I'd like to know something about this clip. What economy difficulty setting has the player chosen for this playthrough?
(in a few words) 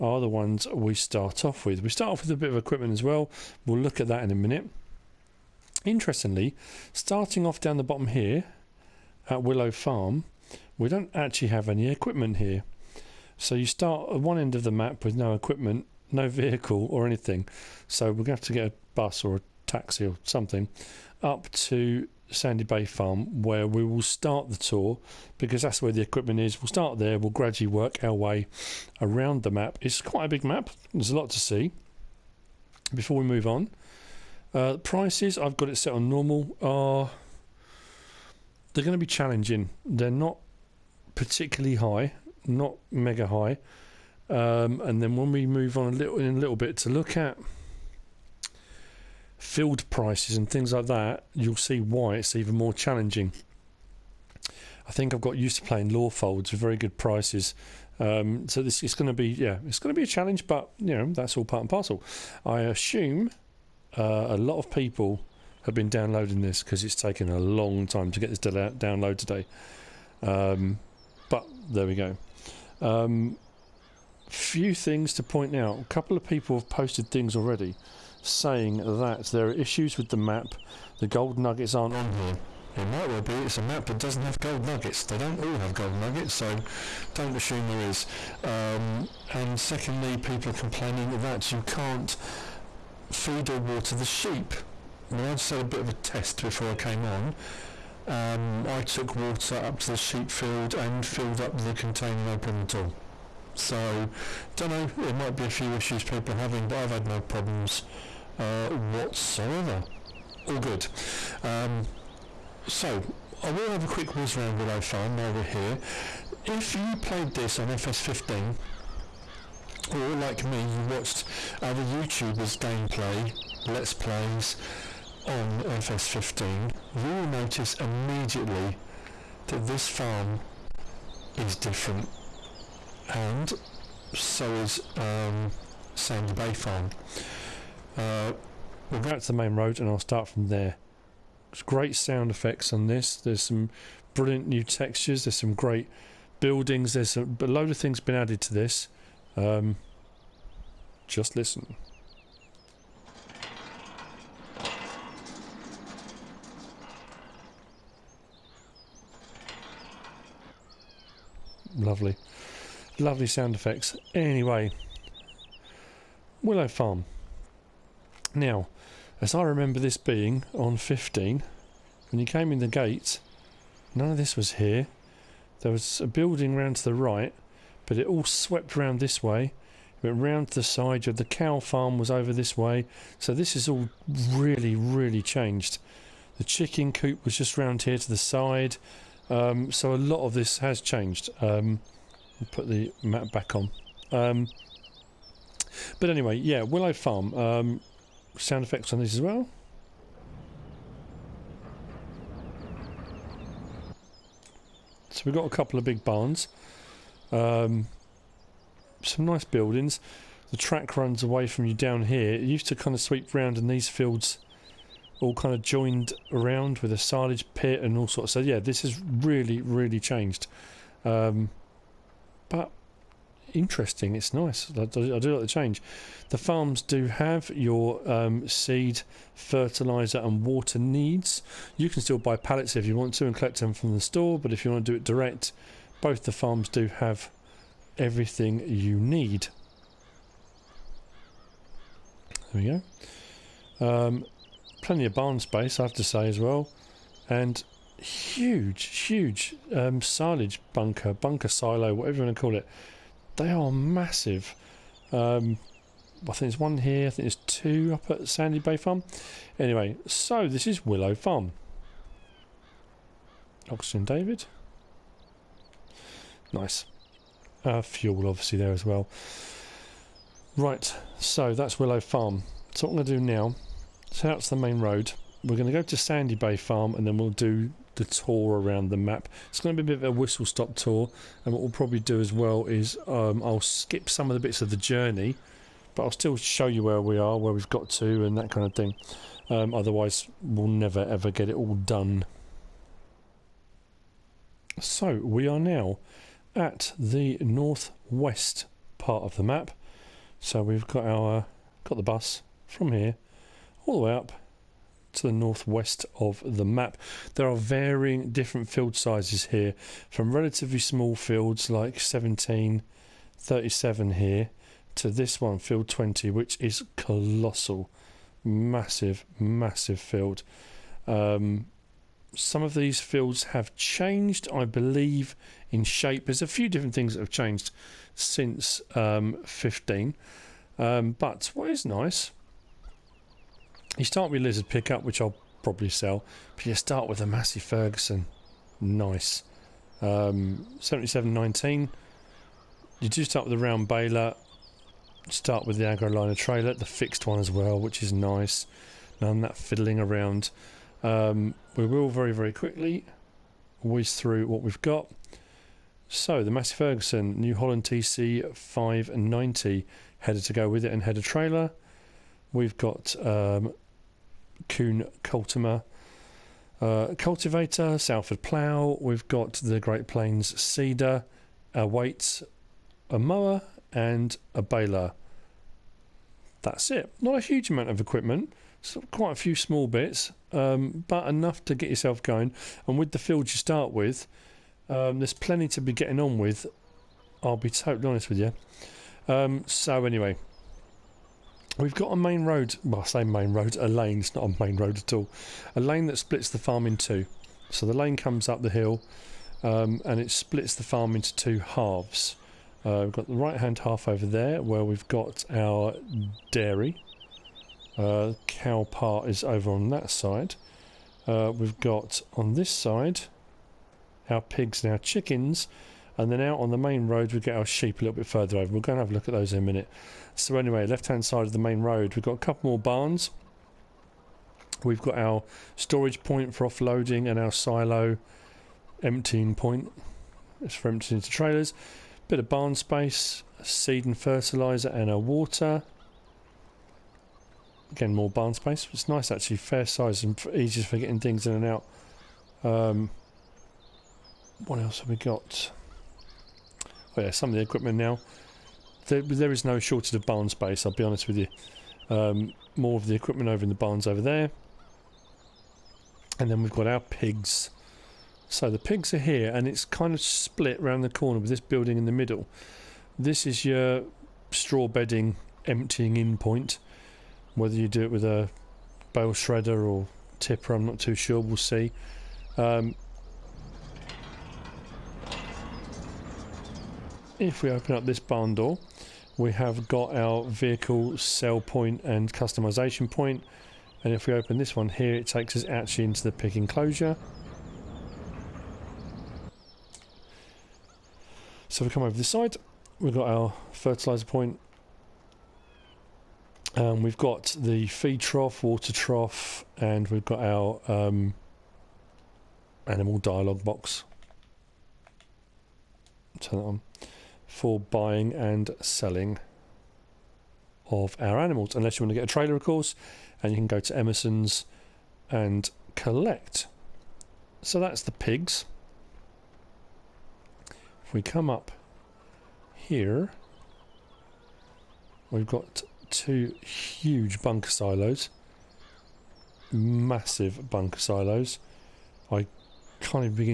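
normal.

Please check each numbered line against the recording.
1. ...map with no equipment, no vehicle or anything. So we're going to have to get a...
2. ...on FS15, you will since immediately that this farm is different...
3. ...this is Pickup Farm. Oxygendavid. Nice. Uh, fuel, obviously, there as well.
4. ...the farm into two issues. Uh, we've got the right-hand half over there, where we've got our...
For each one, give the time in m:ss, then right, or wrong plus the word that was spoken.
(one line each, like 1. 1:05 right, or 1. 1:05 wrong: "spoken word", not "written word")
1. 0:14 right
2. 2:05 wrong: "notice", not "since"
3. 4:20 wrong: "Willow", not "Pickup"
4. 6:40 wrong: "halves", not "issues".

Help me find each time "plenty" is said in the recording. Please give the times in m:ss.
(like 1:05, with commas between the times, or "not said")
4:04, 6:25.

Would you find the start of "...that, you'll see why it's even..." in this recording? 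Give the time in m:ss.
0:50.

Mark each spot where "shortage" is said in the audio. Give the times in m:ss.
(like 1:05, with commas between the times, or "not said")
7:29.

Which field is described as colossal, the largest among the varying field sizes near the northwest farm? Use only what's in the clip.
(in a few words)
field 20.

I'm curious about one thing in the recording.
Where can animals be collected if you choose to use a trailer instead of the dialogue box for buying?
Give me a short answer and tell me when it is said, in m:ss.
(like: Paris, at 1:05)
Emerson's, at 8:33.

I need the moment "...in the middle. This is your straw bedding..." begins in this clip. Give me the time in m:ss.
7:41.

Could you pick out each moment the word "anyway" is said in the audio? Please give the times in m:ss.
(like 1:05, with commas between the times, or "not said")
2:44, 3:16, 4:19, 6:30, 7:00.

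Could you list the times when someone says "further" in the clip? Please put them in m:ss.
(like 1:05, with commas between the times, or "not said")
6:58.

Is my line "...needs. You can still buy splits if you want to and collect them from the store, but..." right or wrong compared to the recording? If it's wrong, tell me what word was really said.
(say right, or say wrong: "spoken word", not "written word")
wrong: "pallets", not "splits".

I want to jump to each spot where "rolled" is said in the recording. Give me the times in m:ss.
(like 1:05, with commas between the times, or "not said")
not said.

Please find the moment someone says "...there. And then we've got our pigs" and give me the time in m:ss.
7:34.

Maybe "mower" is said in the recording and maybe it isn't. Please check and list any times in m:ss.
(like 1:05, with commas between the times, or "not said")
6:13.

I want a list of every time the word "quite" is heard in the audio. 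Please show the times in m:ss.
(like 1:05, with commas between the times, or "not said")
0:30, 6:19.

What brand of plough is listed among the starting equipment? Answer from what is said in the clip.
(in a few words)
Salford.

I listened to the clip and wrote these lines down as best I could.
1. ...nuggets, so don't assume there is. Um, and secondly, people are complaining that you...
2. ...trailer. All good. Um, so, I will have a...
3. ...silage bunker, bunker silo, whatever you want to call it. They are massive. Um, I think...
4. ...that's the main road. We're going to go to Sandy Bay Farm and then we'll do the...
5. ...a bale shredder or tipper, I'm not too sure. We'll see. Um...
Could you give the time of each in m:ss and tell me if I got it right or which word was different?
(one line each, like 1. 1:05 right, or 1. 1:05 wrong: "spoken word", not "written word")
1. 1:25 right
2. 1:48 wrong: "whatsoever", not "trailer"
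3. 4:10 right
4. 4:34 right
5. 7:48 right.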